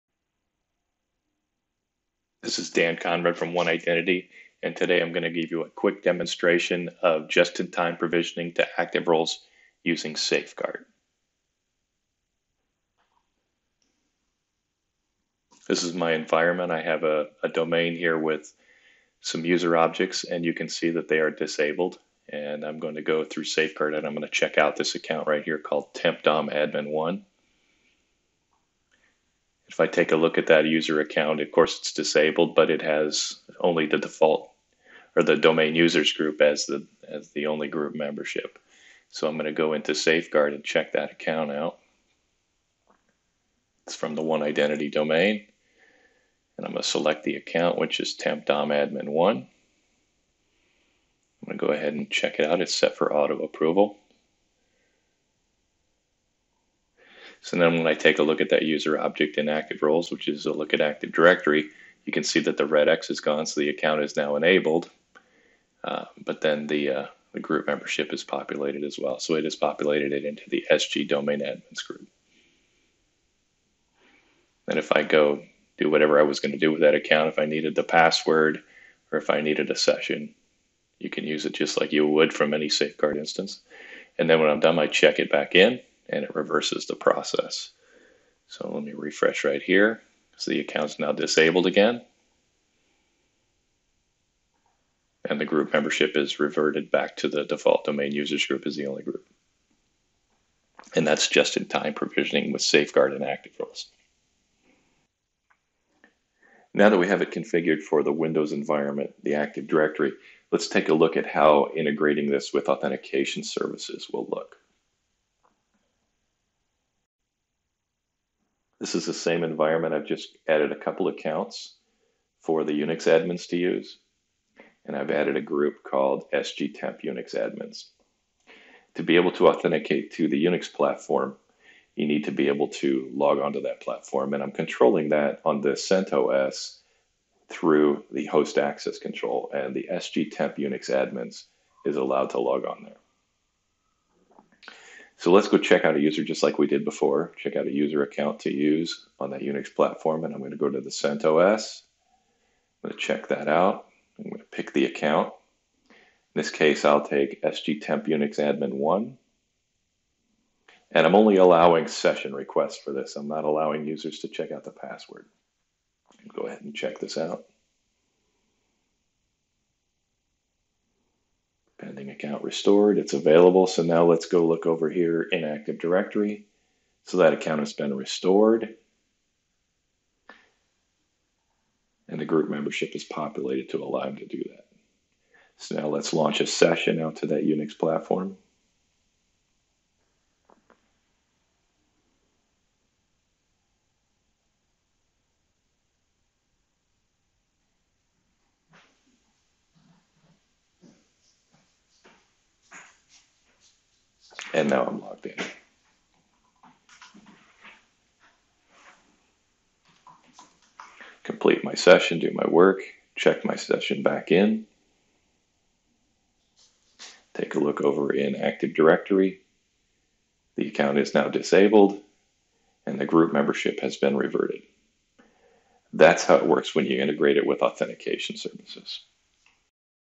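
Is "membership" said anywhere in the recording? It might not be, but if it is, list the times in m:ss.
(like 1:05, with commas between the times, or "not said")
0:37, 1:07, 1:35, 3:02, 3:43.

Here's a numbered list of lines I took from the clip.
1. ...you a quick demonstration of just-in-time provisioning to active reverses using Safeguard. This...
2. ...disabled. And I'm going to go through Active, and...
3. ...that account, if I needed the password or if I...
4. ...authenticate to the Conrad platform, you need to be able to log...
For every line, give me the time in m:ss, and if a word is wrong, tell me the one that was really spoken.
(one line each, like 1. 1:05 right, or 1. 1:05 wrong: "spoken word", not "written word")
1. 0:05 wrong: "roles", not "reverses"
2. 0:21 wrong: "Safeguard", not "Active"
3. 1:16 right
4. 2:09 wrong: "Unix", not "Conrad".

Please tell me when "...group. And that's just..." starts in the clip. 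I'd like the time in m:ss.
1:39.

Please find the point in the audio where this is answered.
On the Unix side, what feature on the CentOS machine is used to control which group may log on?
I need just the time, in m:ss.
2:18.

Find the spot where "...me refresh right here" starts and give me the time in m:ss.
1:28.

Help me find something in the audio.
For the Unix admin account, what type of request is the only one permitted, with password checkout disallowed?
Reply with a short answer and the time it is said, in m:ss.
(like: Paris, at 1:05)
session requests, at 2:41.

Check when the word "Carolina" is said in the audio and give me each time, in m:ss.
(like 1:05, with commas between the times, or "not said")
not said.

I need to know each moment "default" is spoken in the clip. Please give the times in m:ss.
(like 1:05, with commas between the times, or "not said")
0:33, 1:37.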